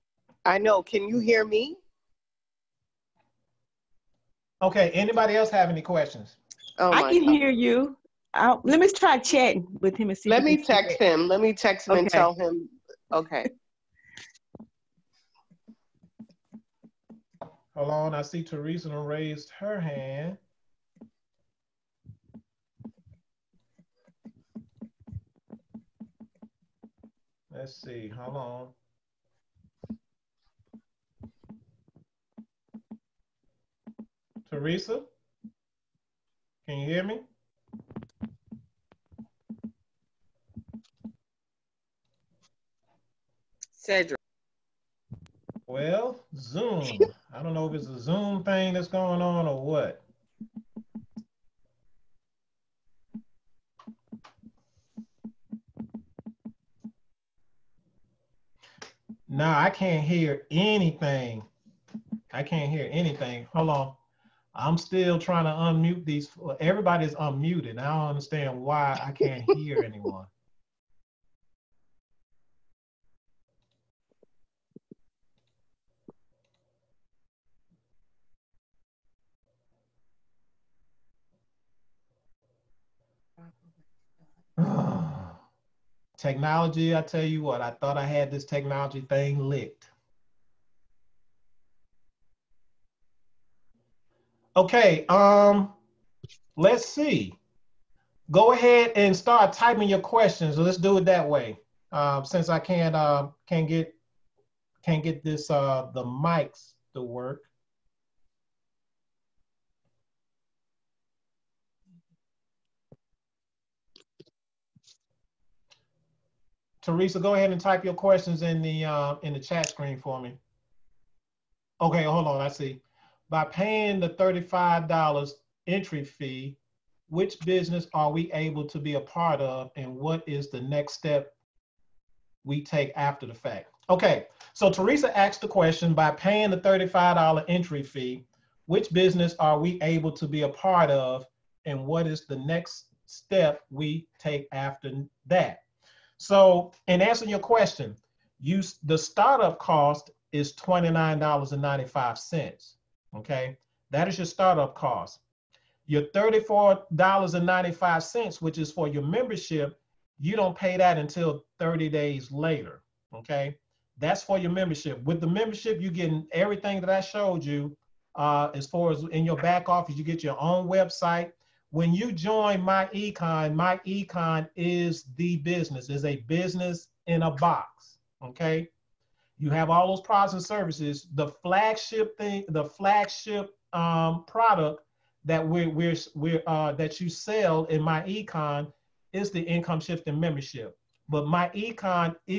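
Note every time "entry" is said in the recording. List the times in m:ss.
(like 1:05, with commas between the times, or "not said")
2:05, 2:17.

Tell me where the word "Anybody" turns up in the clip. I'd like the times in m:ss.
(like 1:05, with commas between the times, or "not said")
0:04.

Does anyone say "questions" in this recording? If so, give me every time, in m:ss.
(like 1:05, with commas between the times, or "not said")
0:05, 1:40, 1:57, 2:15, 2:27.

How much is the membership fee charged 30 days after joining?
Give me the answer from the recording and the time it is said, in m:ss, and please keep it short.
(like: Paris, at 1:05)
$34.95, at 2:36.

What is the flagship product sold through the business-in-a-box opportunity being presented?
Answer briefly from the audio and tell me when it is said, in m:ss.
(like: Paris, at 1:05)
income shifting membership, at 3:09.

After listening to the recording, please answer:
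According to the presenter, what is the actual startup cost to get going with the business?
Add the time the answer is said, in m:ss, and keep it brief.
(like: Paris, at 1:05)
$29.95, at 2:30.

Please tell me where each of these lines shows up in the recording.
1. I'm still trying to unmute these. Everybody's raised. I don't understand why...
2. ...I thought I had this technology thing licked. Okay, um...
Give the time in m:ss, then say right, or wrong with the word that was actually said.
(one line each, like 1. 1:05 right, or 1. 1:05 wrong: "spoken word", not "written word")
1. 1:04 wrong: "unmuted", not "raised"
2. 1:27 right.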